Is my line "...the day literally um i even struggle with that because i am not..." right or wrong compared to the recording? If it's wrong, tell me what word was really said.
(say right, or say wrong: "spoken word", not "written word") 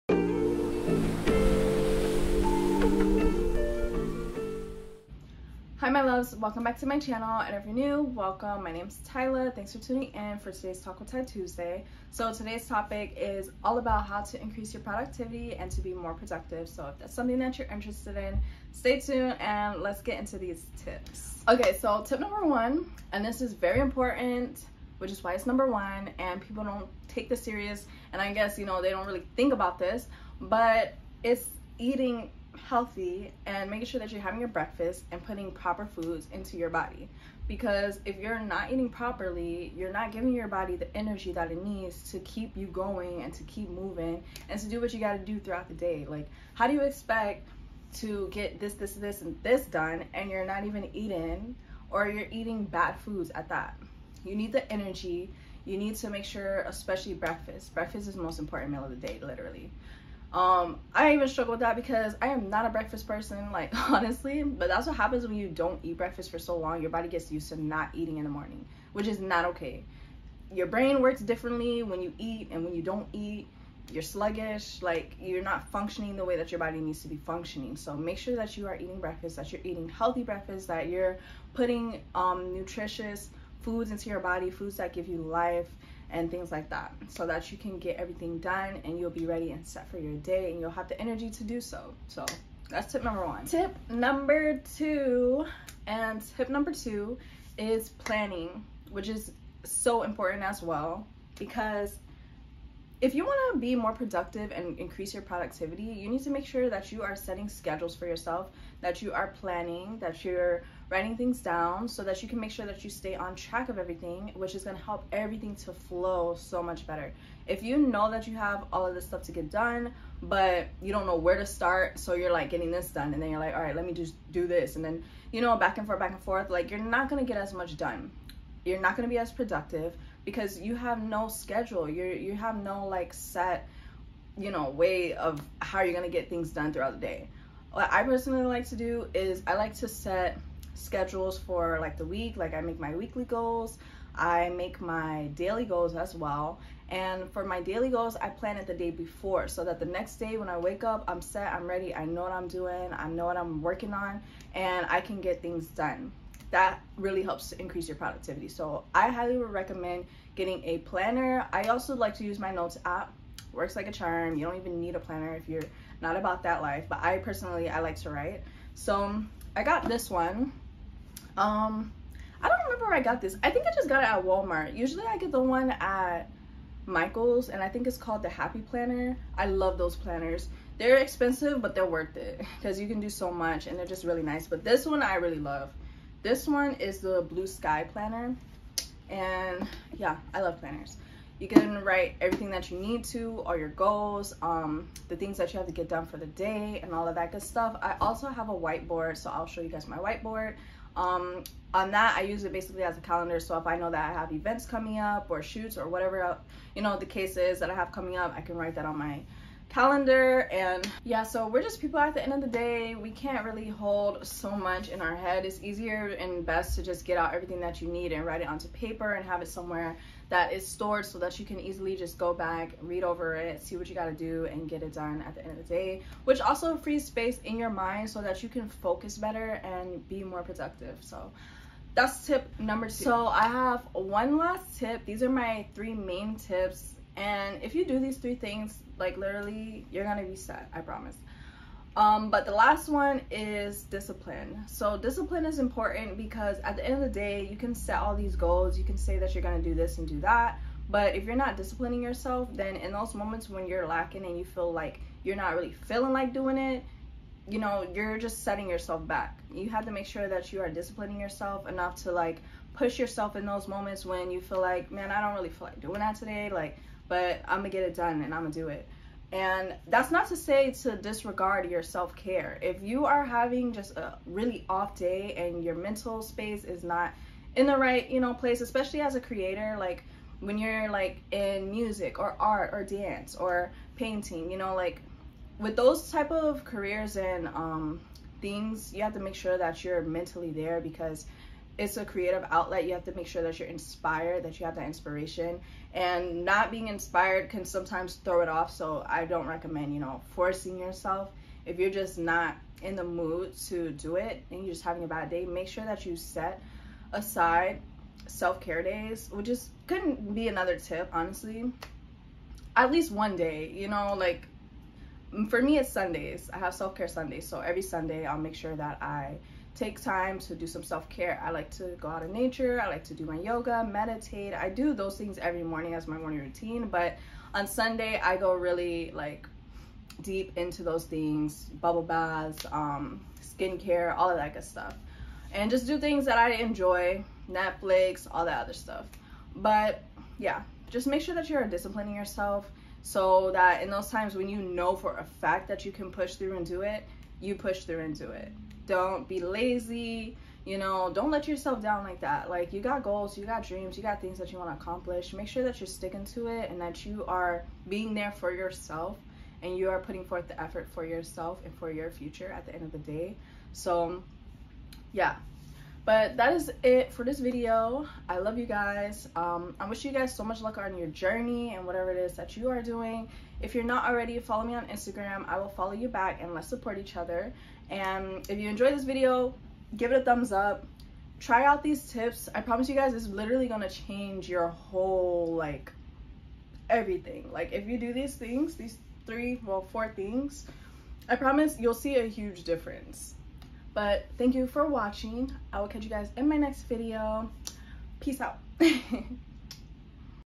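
right.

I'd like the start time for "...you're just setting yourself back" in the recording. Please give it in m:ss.
4:17.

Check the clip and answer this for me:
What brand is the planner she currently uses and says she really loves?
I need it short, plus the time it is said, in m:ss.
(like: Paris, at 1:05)
Blue Sky Planner, at 3:07.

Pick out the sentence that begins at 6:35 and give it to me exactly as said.
I will catch you guys in my next video.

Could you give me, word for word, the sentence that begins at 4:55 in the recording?
And not being inspired can sometimes throw it off.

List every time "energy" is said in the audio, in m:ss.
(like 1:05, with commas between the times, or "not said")
0:40, 0:54, 1:30.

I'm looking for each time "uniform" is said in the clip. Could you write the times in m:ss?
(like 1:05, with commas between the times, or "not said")
not said.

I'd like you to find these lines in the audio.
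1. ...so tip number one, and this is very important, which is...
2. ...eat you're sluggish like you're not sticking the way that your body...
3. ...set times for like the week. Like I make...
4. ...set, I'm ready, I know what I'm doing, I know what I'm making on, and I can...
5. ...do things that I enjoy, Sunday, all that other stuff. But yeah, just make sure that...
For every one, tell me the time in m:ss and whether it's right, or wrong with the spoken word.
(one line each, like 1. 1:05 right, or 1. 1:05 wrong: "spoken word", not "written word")
1. 0:21 right
2. 1:13 wrong: "functioning", not "sticking"
3. 2:19 wrong: "schedules", not "times"
4. 2:31 wrong: "working", not "making"
5. 5:35 wrong: "Netflix", not "Sunday".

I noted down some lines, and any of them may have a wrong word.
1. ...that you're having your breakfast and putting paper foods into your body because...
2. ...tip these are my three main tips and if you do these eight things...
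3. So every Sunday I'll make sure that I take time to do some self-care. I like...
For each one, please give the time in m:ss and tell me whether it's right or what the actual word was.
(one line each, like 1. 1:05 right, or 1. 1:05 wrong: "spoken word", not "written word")
1. 0:33 wrong: "proper", not "paper"
2. 3:54 wrong: "three", not "eight"
3. 5:17 right.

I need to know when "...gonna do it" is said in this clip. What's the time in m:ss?
4:28.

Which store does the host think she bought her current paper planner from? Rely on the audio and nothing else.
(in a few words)
Walmart.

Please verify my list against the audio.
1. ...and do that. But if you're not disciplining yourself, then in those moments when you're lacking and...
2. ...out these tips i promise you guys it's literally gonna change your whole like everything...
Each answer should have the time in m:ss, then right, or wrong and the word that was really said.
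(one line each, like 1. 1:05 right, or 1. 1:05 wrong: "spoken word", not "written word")
1. 4:09 right
2. 6:21 right.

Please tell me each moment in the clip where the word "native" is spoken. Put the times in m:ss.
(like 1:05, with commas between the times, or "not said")
not said.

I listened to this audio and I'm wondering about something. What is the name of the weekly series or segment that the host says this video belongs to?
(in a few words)
Talk with Tyy Tuesday.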